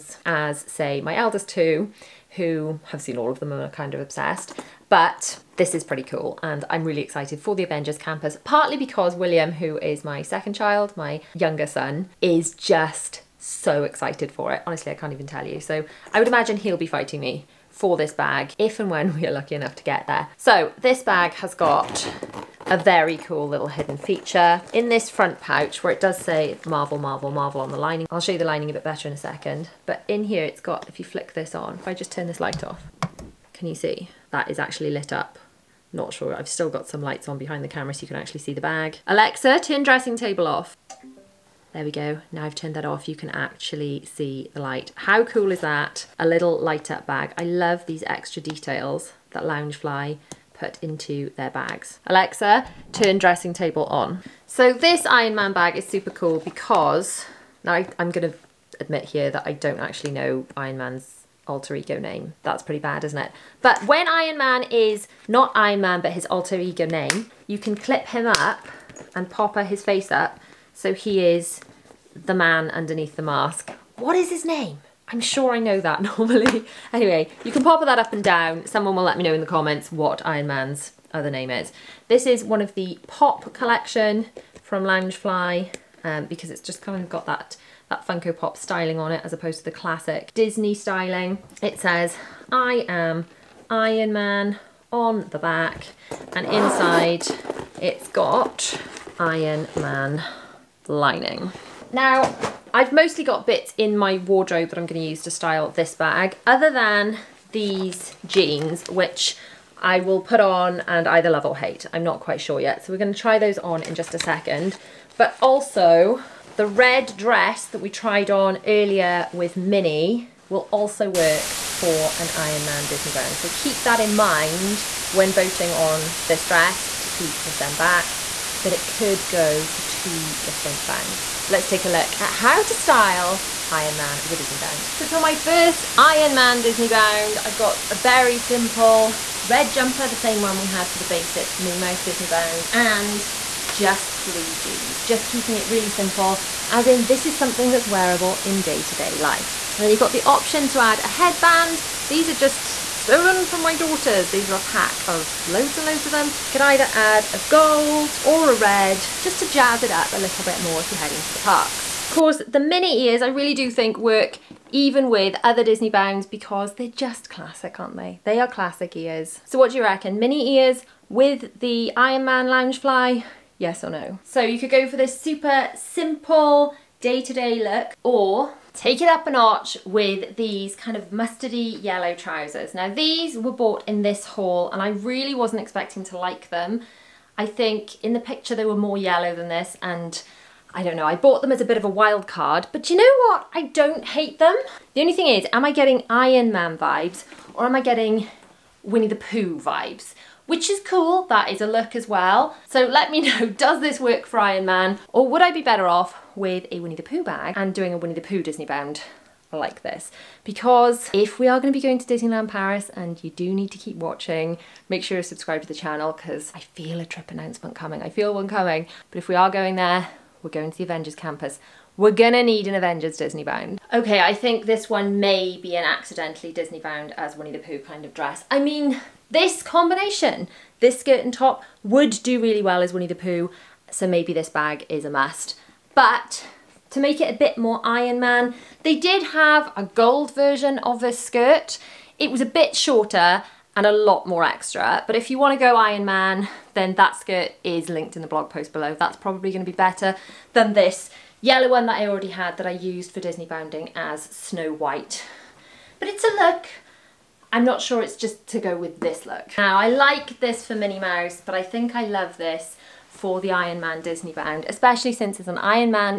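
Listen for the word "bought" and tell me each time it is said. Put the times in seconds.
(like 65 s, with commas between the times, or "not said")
183 s, 191 s.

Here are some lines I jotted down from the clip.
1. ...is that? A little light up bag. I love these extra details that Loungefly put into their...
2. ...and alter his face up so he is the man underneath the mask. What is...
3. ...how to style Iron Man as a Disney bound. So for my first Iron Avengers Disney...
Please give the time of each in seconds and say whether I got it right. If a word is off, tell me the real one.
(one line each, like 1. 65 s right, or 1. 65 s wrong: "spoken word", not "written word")
1. 45 s right
2. 69 s wrong: "popper", not "alter"
3. 132 s wrong: "Man", not "Avengers".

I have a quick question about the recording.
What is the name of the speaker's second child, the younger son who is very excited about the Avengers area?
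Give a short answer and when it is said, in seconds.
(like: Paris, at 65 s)
William, at 9 s.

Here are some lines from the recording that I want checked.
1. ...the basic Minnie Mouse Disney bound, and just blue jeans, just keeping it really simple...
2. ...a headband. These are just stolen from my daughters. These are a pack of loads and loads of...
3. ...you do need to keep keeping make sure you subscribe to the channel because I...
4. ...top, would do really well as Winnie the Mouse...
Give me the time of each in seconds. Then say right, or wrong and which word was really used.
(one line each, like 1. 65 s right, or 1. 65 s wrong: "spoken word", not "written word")
1. 140 s right
2. 150 s right
3. 213 s wrong: "watching", not "keeping"
4. 231 s wrong: "Pooh", not "Mouse".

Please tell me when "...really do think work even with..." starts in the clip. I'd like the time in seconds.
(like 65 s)
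163 s.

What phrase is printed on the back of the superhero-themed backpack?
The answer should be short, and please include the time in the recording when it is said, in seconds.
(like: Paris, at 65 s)
I am Iron Man, at 92 s.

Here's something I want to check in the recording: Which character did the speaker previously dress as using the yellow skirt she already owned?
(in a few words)
Snow White.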